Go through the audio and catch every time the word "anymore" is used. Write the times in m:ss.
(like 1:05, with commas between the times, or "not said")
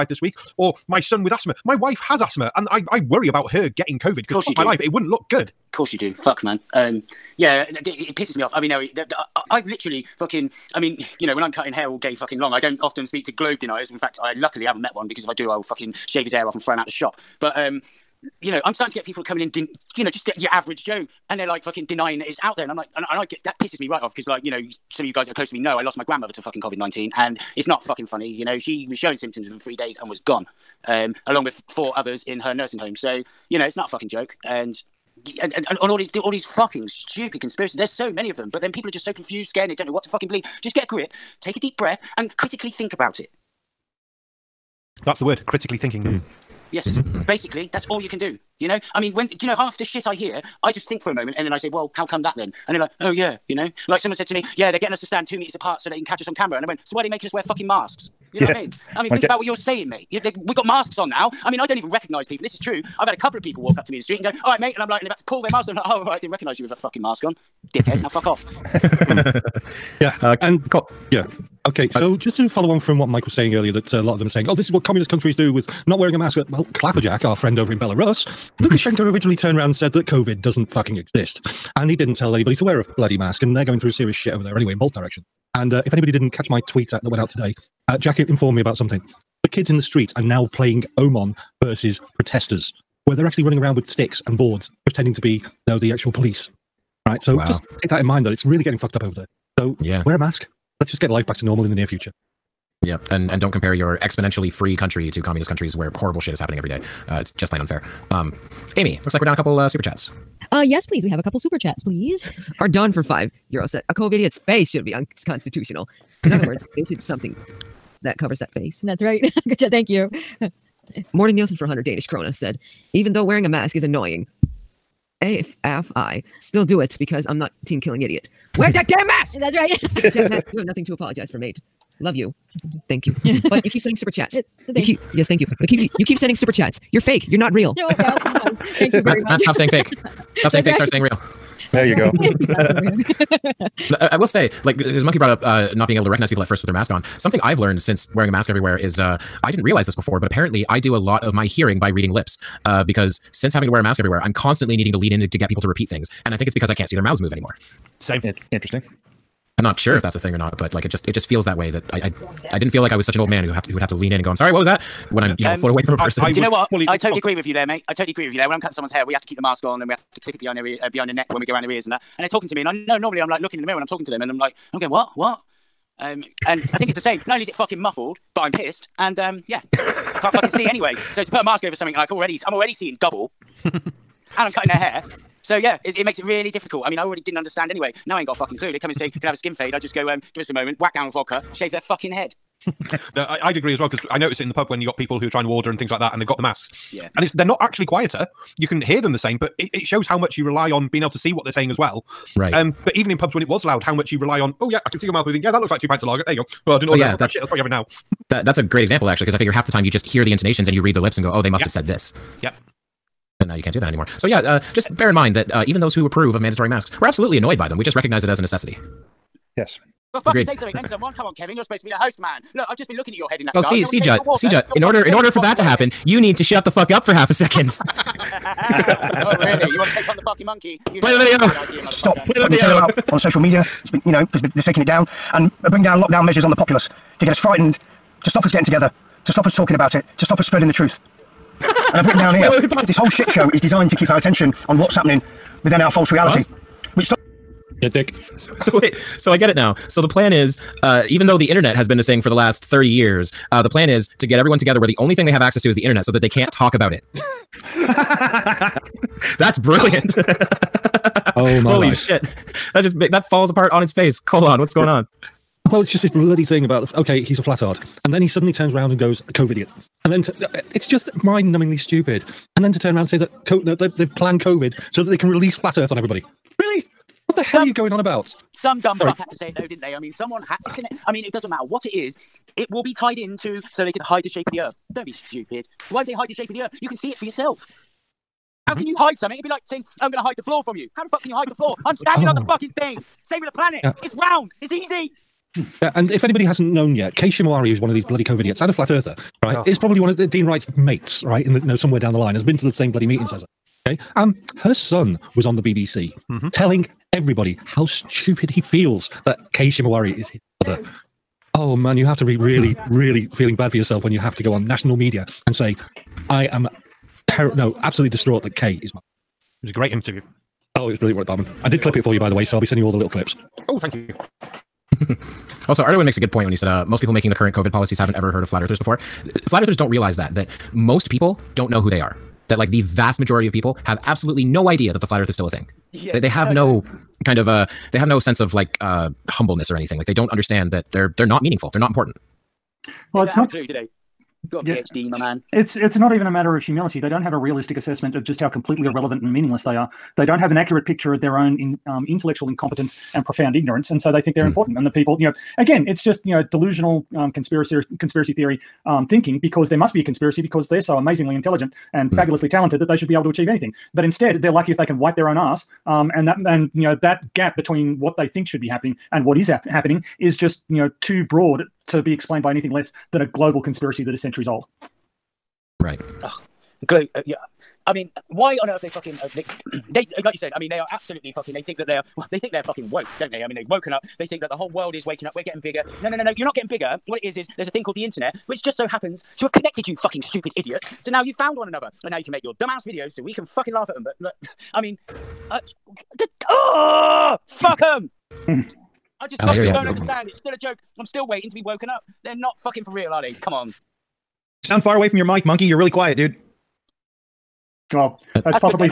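2:37, 3:33.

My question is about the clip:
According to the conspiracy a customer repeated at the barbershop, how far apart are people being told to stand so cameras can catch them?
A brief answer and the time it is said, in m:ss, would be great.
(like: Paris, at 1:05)
2 meters, at 0:55.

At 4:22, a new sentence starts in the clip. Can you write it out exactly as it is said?
That just that falls apart on its face.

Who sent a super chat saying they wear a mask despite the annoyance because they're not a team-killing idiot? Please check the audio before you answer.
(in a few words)
Morten Nielsen.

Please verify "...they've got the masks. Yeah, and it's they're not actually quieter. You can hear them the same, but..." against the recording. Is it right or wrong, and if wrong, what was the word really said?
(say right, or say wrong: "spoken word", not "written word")
right.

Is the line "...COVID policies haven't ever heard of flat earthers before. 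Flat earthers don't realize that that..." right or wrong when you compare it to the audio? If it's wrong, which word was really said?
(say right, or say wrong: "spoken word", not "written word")
right.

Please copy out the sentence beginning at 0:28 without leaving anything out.
You know, she was showing symptoms in three days and was gone, um, along with four others in her nursing home.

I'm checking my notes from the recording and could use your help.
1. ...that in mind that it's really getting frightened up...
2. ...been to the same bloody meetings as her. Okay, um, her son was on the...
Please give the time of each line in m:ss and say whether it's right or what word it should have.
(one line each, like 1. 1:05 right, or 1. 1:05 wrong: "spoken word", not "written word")
1. 1:37 wrong: "fucked", not "frightened"
2. 5:02 right.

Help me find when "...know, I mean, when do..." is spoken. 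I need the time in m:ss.
0:48.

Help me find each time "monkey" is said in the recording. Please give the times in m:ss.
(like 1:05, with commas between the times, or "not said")
2:25, 3:50, 6:45.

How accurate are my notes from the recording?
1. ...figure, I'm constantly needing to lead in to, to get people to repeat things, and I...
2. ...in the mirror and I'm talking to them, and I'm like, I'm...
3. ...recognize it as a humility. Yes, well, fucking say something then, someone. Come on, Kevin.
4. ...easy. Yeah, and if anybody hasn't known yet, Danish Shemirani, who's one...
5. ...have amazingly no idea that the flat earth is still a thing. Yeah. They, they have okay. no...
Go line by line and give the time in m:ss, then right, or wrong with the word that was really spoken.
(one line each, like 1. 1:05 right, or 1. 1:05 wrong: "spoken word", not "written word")
1. 2:33 wrong: "everywhere", not "figure"
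2. 2:53 right
3. 3:37 wrong: "necessity", not "humility"
4. 4:54 wrong: "Kate", not "Danish"
5. 5:33 wrong: "absolutely", not "amazingly".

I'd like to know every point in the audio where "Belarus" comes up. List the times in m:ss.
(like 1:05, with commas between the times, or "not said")
1:17.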